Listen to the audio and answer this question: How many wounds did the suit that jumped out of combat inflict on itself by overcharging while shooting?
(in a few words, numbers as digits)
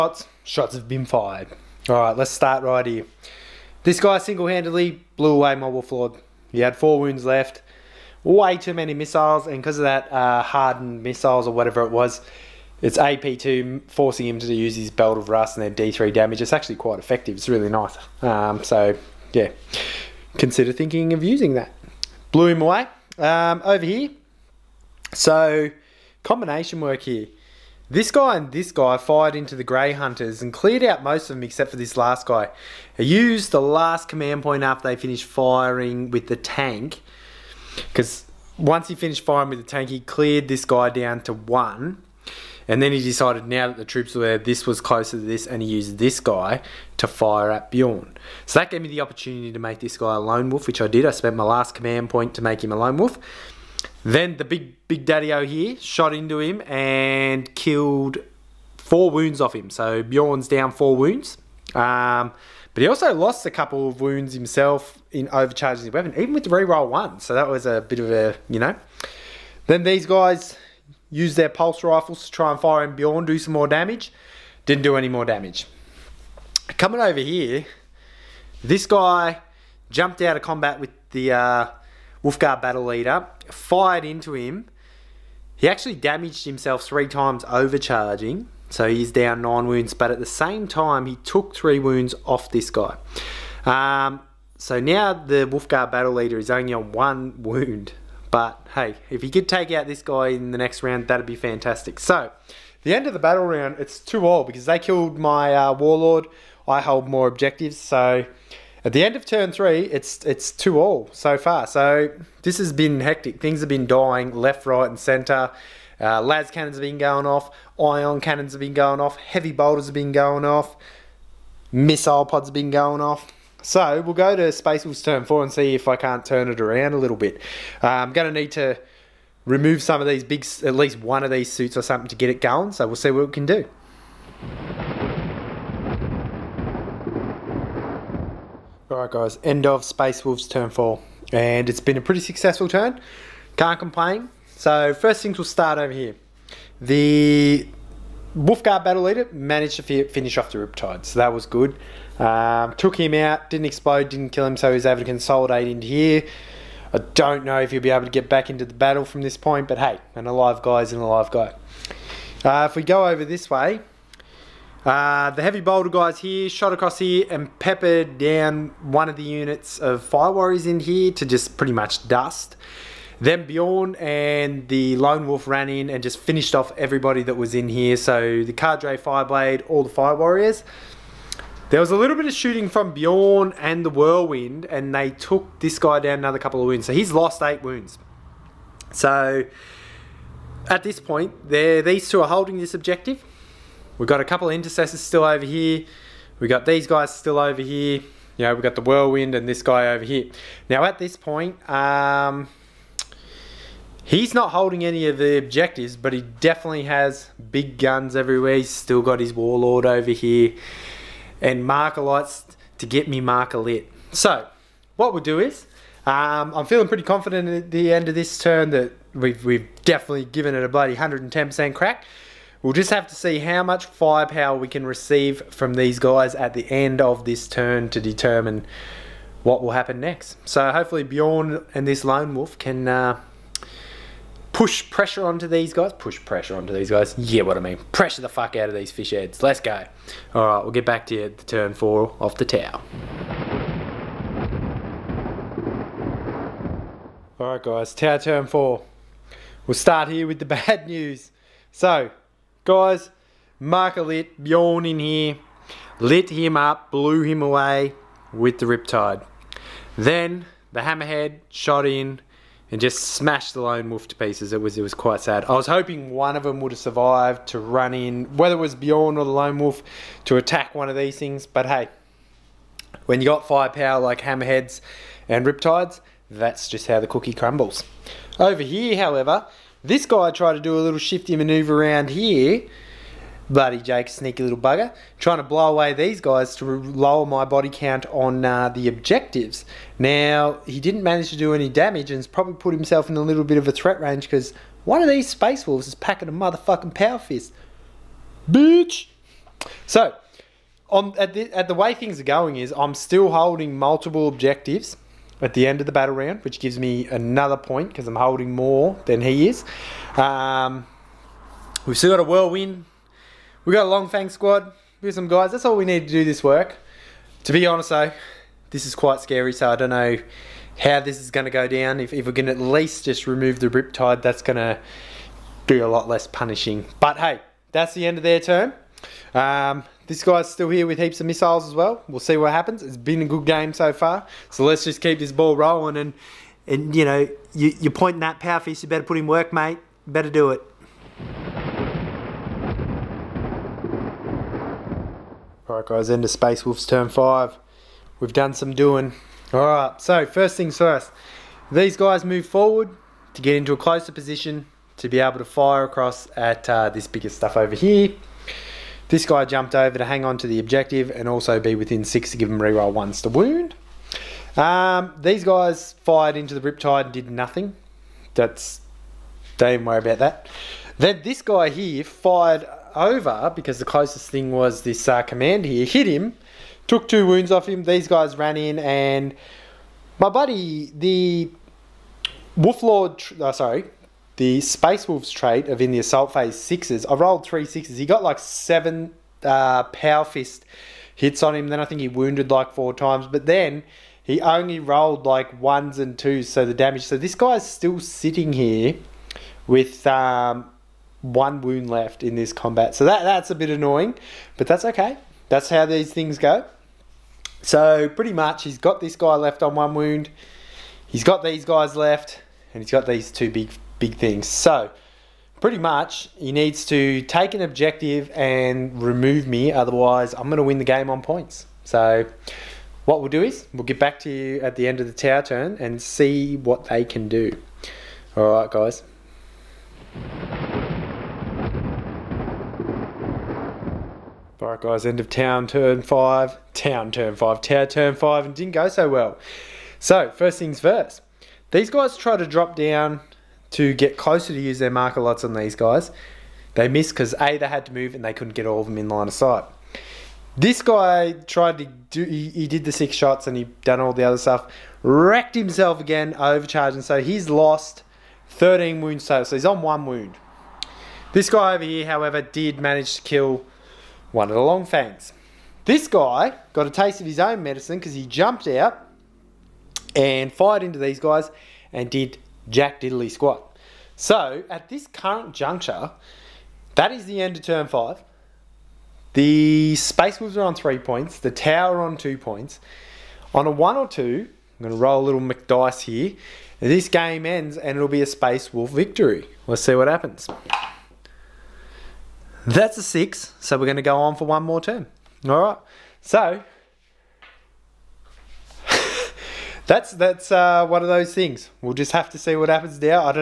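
9.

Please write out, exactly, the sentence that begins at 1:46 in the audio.
I hold more objectives, so at the end of turn three, it's it's two all so far.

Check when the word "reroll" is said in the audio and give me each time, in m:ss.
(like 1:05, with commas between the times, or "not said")
1:06, 6:02.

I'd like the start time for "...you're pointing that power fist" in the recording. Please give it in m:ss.
5:37.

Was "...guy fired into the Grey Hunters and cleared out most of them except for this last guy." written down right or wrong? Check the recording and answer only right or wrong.
right.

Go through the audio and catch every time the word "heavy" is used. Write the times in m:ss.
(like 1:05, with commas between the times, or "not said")
1:59, 2:45.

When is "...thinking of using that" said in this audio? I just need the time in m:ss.
0:20.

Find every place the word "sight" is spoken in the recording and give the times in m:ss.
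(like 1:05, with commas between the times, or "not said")
7:29.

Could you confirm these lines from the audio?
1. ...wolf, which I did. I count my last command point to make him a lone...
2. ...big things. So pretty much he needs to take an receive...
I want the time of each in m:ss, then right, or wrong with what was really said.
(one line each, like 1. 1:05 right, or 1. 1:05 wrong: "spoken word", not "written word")
1. 0:50 wrong: "spent", not "count"
2. 6:53 wrong: "objective", not "receive".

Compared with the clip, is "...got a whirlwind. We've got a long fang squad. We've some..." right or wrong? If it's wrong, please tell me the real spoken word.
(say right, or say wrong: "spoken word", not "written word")
right.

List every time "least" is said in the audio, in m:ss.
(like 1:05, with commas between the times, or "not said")
2:10, 5:22.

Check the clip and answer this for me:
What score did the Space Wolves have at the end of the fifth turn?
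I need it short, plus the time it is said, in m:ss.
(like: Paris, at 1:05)
3, at 8:00.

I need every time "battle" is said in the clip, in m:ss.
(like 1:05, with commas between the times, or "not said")
1:22, 1:35, 1:43, 2:28, 2:38, 5:05.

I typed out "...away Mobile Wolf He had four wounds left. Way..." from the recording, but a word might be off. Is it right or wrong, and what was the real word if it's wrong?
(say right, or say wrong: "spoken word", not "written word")
right.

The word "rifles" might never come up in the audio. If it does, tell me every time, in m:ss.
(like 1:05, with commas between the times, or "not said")
1:11.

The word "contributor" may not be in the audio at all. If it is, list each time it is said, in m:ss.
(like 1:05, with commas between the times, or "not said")
not said.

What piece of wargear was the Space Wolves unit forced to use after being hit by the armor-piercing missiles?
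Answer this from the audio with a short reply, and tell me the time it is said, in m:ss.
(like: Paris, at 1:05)
Belt of Russ, at 0:14.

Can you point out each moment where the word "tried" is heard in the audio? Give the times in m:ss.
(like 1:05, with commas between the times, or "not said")
4:40, 7:31.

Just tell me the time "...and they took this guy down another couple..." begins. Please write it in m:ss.
3:04.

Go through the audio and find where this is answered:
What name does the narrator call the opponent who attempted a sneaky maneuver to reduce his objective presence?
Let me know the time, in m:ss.
4:43.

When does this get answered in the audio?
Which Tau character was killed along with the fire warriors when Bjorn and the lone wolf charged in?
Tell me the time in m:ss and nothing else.
2:58.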